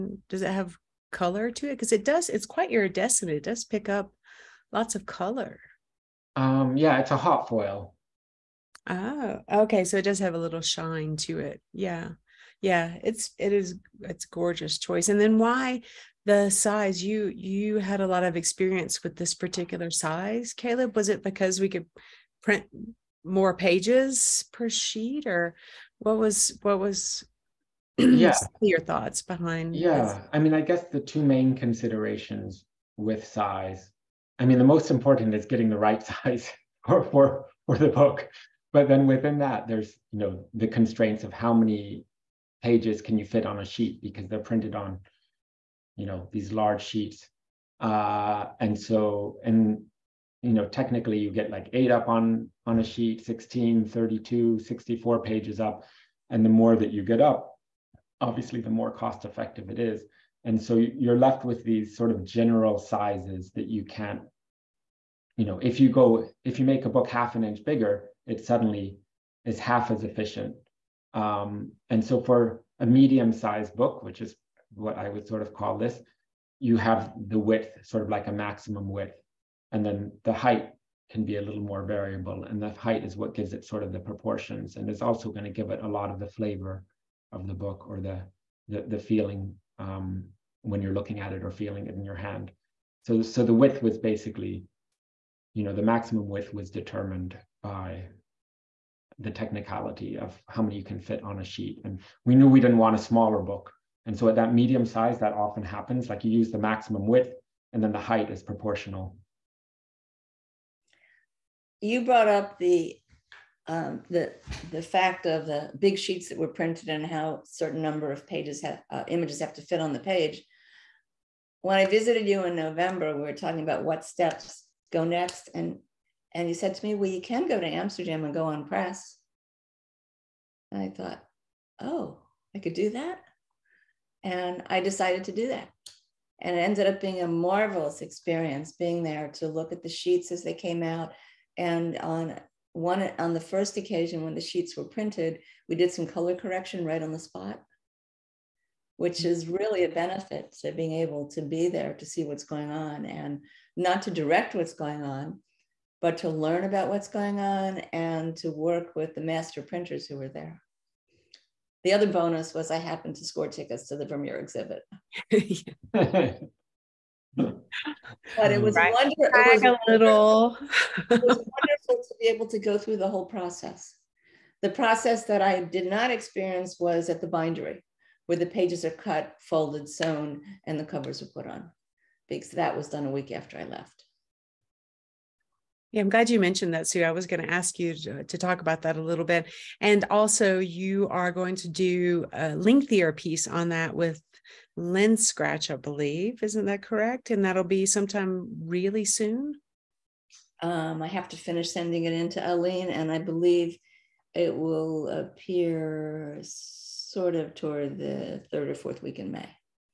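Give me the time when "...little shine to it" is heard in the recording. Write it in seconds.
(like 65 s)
10 s.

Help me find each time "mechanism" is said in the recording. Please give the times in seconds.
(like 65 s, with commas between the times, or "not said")
not said.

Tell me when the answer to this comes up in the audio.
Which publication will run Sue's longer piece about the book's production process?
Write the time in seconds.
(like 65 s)
194 s.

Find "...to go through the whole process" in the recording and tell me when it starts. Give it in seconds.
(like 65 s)
172 s.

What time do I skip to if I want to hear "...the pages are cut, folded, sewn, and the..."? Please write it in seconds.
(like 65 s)
178 s.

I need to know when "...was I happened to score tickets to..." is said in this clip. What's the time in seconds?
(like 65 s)
162 s.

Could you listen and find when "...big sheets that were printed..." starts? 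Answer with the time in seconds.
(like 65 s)
115 s.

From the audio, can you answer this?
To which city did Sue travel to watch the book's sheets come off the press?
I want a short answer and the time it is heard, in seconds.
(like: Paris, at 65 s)
Amsterdam, at 127 s.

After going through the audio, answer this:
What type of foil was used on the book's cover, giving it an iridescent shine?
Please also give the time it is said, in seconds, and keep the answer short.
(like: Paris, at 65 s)
Hot foil, at 7 s.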